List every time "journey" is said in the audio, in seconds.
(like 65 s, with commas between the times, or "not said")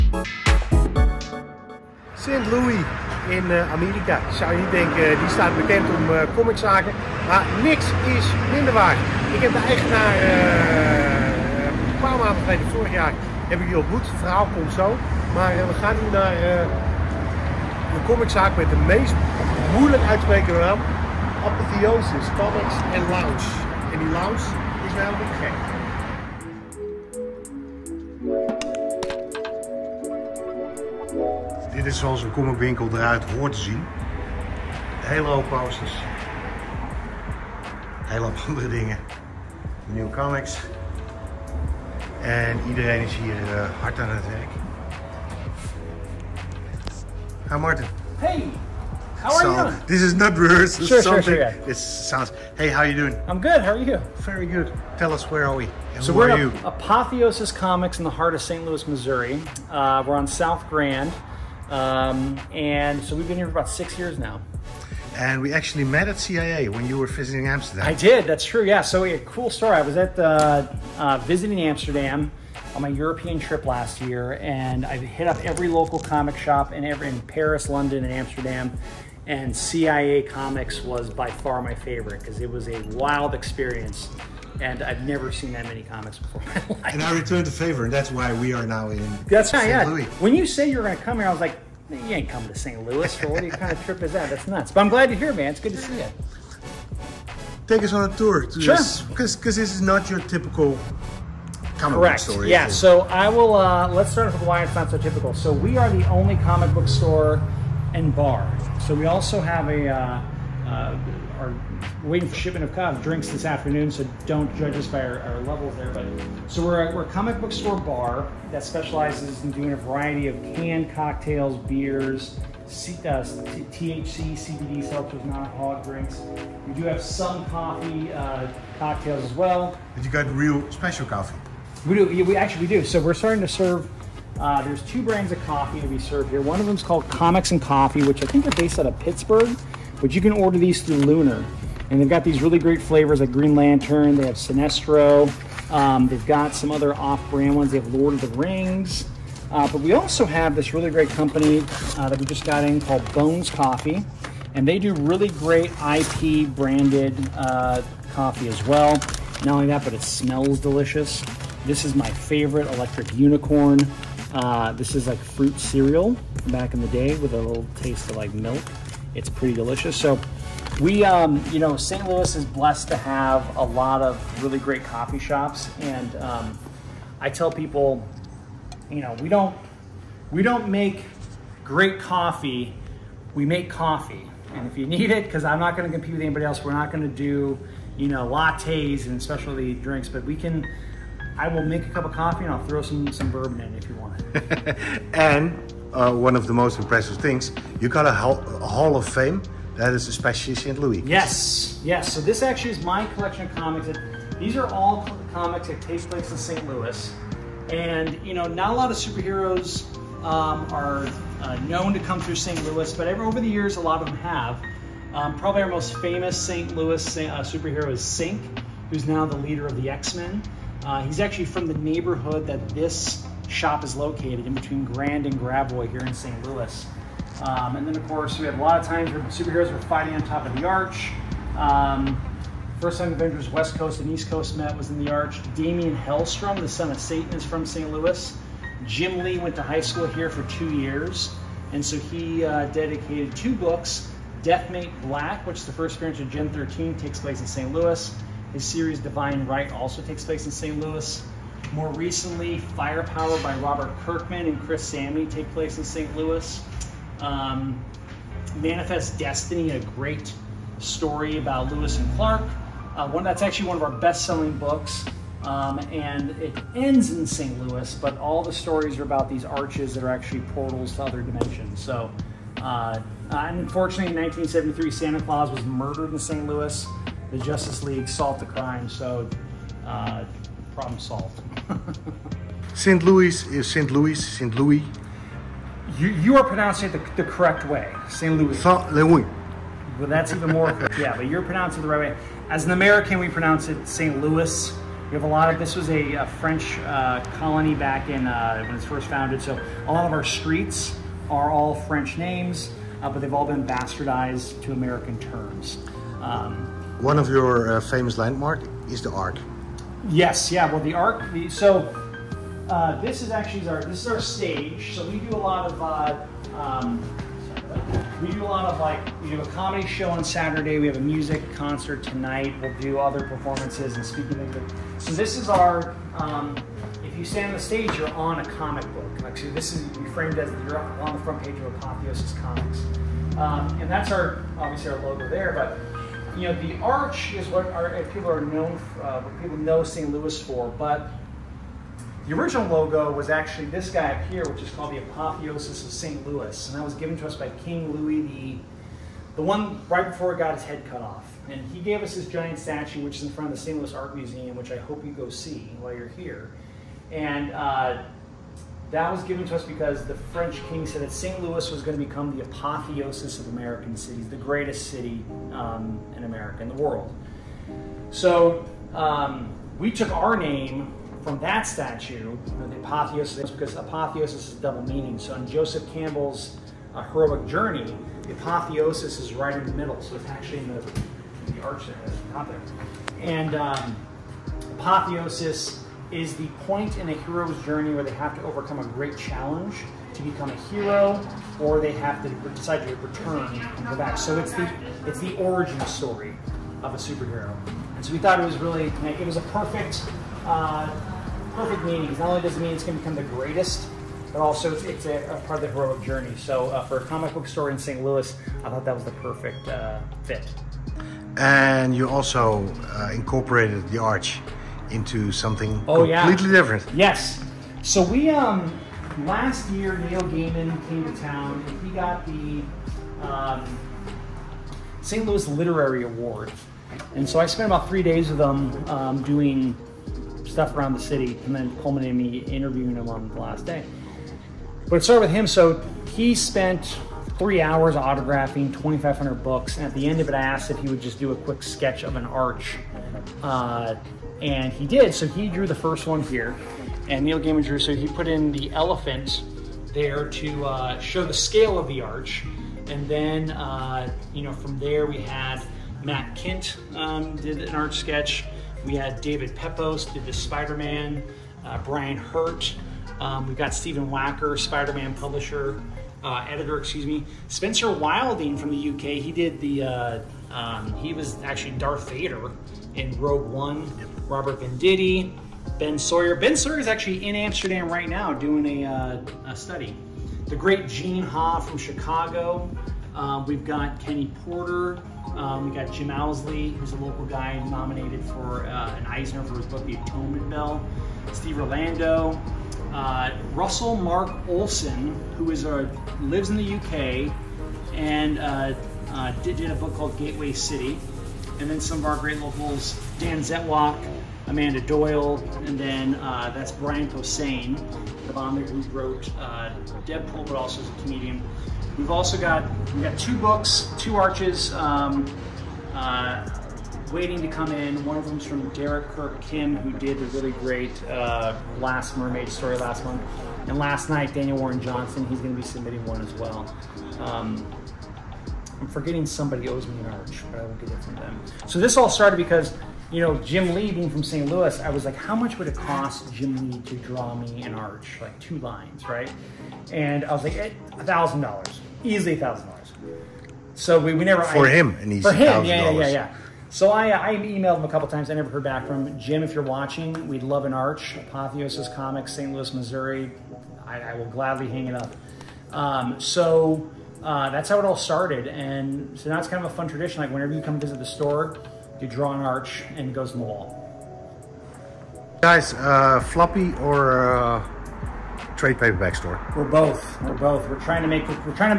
377 s, 387 s, 406 s.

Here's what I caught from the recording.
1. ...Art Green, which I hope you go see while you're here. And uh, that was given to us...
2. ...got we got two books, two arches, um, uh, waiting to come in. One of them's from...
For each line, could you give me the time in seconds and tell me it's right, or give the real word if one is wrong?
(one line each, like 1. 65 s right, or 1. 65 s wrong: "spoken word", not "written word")
1. 353 s wrong: "Museum", not "Green"
2. 512 s right.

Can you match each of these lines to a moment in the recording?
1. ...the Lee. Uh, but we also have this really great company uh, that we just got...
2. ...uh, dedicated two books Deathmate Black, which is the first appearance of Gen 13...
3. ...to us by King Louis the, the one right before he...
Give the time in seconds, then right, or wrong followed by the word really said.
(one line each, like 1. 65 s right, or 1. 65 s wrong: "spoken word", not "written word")
1. 148 s wrong: "Rings", not "Lee"
2. 242 s right
3. 347 s right.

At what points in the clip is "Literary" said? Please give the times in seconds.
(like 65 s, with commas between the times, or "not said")
425 s.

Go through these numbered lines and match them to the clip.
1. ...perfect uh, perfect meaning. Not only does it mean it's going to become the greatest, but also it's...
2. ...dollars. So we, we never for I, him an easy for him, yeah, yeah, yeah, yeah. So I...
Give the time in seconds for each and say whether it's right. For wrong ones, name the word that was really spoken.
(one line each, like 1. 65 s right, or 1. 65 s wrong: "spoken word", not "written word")
1. 399 s right
2. 542 s right.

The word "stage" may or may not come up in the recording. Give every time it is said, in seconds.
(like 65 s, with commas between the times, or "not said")
314 s, 327 s.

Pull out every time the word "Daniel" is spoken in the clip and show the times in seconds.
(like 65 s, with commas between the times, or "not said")
524 s.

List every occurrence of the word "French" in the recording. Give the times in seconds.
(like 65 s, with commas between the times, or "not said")
296 s, 301 s, 360 s.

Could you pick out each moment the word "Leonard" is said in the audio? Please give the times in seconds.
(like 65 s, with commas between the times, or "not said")
not said.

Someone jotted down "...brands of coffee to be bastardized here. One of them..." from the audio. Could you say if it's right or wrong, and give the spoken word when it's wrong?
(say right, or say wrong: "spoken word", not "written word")
wrong: "served", not "bastardized".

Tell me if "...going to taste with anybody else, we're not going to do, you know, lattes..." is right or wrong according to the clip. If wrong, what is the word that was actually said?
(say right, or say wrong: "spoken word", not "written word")
wrong: "compete", not "taste".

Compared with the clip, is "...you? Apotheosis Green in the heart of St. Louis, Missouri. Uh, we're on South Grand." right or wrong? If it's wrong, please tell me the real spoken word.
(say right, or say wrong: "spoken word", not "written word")
wrong: "Comics", not "Green".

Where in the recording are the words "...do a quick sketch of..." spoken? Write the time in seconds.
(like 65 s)
441 s.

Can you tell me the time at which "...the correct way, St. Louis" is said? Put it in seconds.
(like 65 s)
287 s.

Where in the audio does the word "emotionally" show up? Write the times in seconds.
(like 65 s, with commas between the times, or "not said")
not said.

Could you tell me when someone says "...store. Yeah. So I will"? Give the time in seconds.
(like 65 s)
102 s.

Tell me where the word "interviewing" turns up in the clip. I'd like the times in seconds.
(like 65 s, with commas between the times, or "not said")
432 s.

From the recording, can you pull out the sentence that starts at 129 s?
But you got real special coffee.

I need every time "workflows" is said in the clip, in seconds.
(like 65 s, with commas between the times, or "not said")
not said.